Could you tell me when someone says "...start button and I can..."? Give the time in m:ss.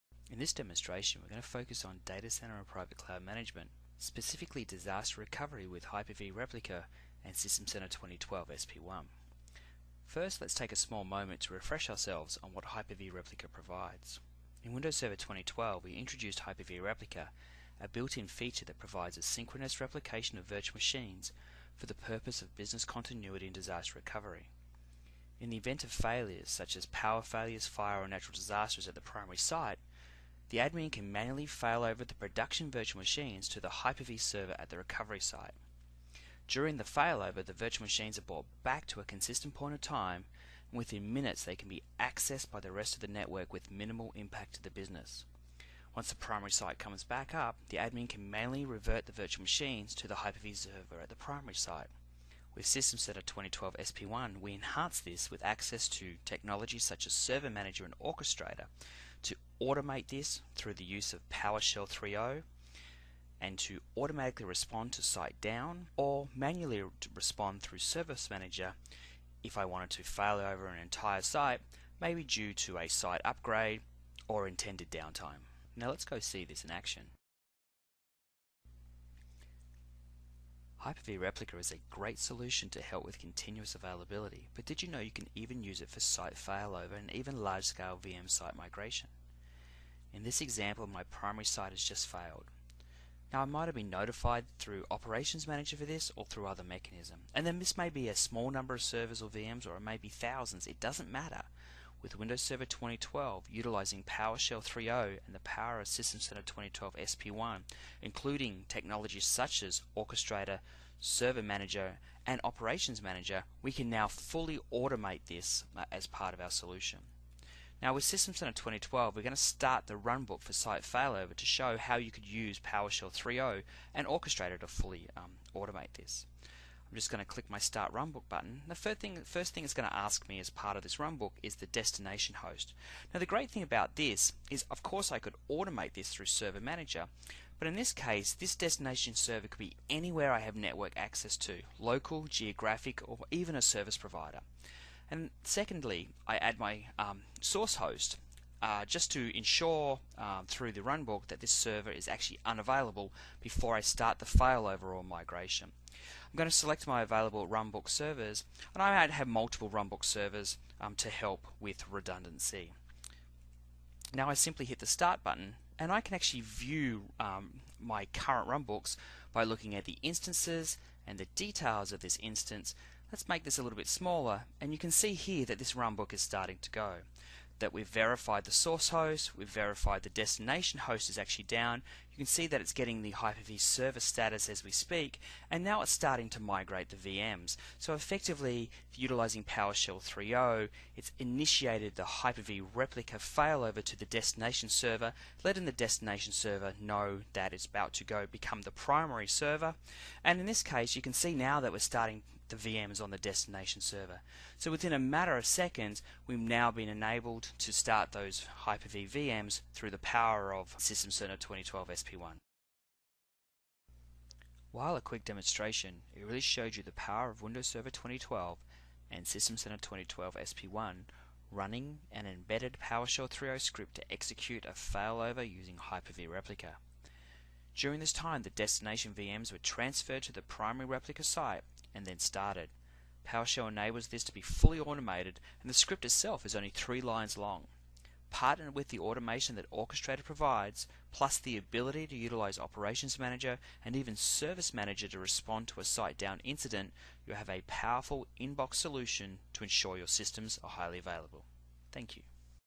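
2:44.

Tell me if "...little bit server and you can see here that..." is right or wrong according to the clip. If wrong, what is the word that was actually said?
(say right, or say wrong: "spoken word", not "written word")
wrong: "smaller", not "server".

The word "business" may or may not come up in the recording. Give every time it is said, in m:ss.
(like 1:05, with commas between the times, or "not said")
0:22, 0:44.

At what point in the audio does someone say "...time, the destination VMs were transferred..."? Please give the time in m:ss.
3:48.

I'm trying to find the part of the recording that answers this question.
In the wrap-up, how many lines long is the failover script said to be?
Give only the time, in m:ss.
3:56.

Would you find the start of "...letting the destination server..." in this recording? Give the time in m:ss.
3:15.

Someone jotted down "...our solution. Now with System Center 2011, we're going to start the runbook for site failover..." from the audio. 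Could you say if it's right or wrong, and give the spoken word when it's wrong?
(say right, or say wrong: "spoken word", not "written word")
wrong: "2012", not "2011".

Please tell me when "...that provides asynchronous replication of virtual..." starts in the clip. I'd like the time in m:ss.
0:18.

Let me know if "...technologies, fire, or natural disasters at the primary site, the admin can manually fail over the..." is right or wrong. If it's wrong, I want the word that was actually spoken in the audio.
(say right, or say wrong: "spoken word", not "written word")
wrong: "failures", not "technologies".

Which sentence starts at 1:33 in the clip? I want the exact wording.
Now I might have been notified through Operations Manager for this or through other mechanism.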